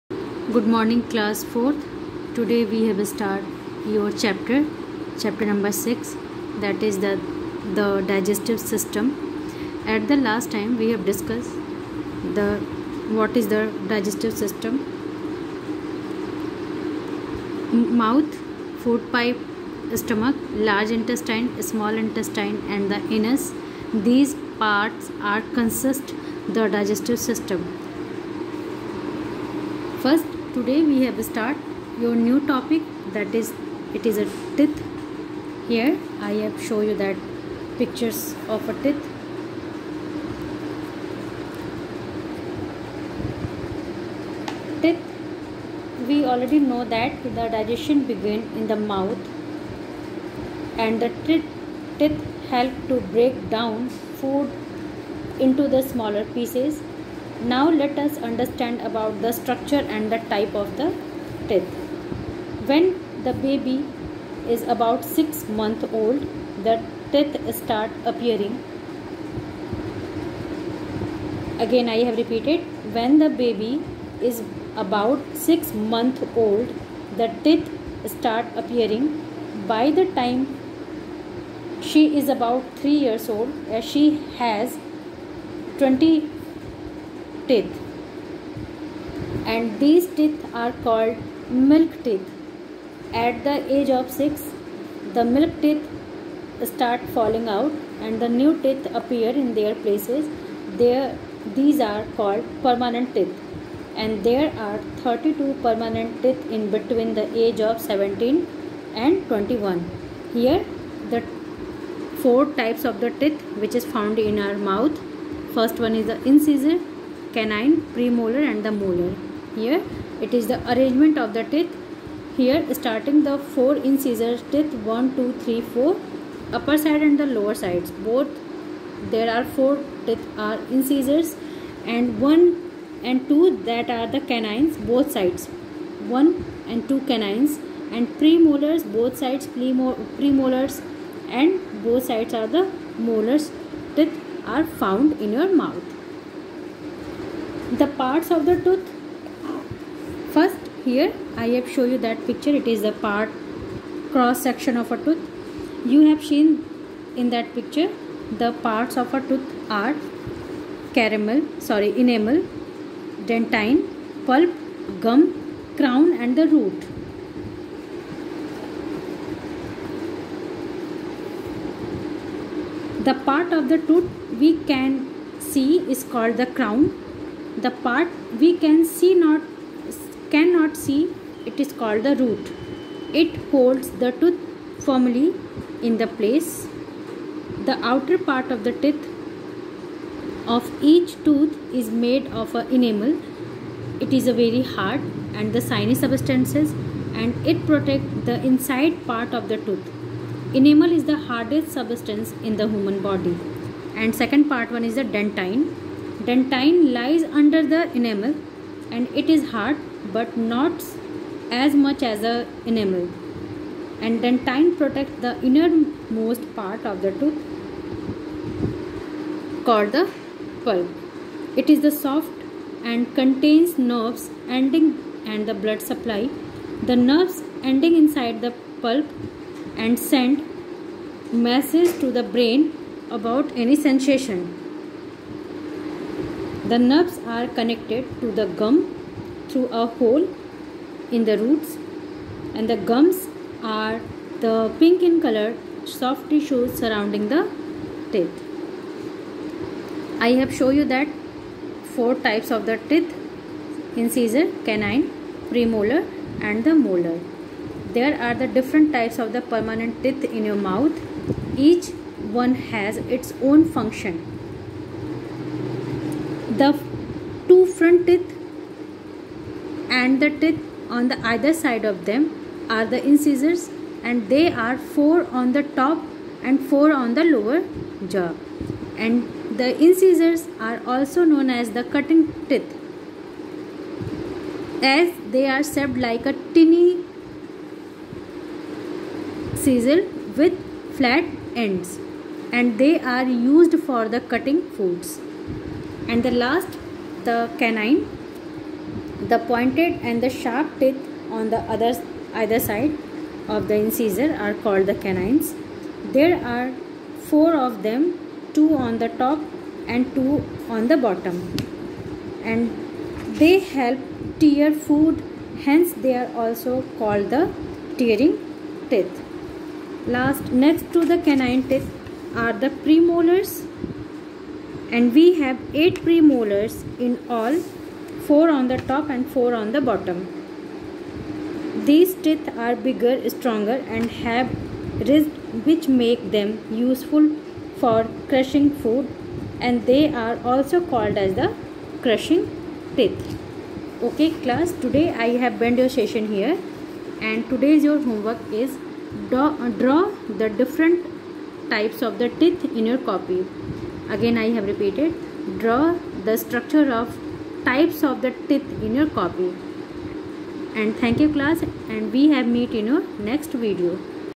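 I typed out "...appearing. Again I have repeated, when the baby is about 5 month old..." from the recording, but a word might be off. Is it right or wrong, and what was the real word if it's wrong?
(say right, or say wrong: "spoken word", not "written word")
wrong: "6", not "5".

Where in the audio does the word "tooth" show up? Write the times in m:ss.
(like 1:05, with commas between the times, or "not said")
2:28, 2:35, 2:39, 2:53, 3:04, 3:11, 3:19, 3:37.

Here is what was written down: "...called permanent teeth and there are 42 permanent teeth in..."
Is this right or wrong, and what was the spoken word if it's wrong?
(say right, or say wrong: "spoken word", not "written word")
wrong: "32", not "42".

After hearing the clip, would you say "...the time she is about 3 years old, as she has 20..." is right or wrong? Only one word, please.
right.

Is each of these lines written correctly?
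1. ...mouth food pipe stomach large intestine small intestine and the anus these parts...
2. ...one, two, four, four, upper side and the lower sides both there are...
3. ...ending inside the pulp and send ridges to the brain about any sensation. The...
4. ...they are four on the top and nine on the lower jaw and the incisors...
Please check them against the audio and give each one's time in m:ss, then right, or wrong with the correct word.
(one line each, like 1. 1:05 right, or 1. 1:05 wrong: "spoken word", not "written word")
1. 0:18 right
2. 2:04 wrong: "three", not "four"
3. 3:47 wrong: "messages", not "ridges"
4. 4:34 wrong: "four", not "nine".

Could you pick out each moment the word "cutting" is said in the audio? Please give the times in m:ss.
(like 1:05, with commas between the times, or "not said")
4:41, 4:54.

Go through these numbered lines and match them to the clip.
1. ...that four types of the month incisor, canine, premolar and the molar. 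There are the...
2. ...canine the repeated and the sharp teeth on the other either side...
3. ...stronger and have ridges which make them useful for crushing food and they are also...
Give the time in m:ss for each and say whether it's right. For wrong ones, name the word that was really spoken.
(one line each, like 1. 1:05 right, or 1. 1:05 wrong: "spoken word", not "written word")
1. 4:10 wrong: "teeth", not "month"
2. 4:57 wrong: "pointed", not "repeated"
3. 5:33 right.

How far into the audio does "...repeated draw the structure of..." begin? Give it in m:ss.
5:54.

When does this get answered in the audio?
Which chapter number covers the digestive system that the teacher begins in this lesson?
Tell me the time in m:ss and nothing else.
0:05.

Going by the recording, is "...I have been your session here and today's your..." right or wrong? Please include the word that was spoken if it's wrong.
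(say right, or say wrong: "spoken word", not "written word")
right.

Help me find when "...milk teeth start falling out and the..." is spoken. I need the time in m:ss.
1:35.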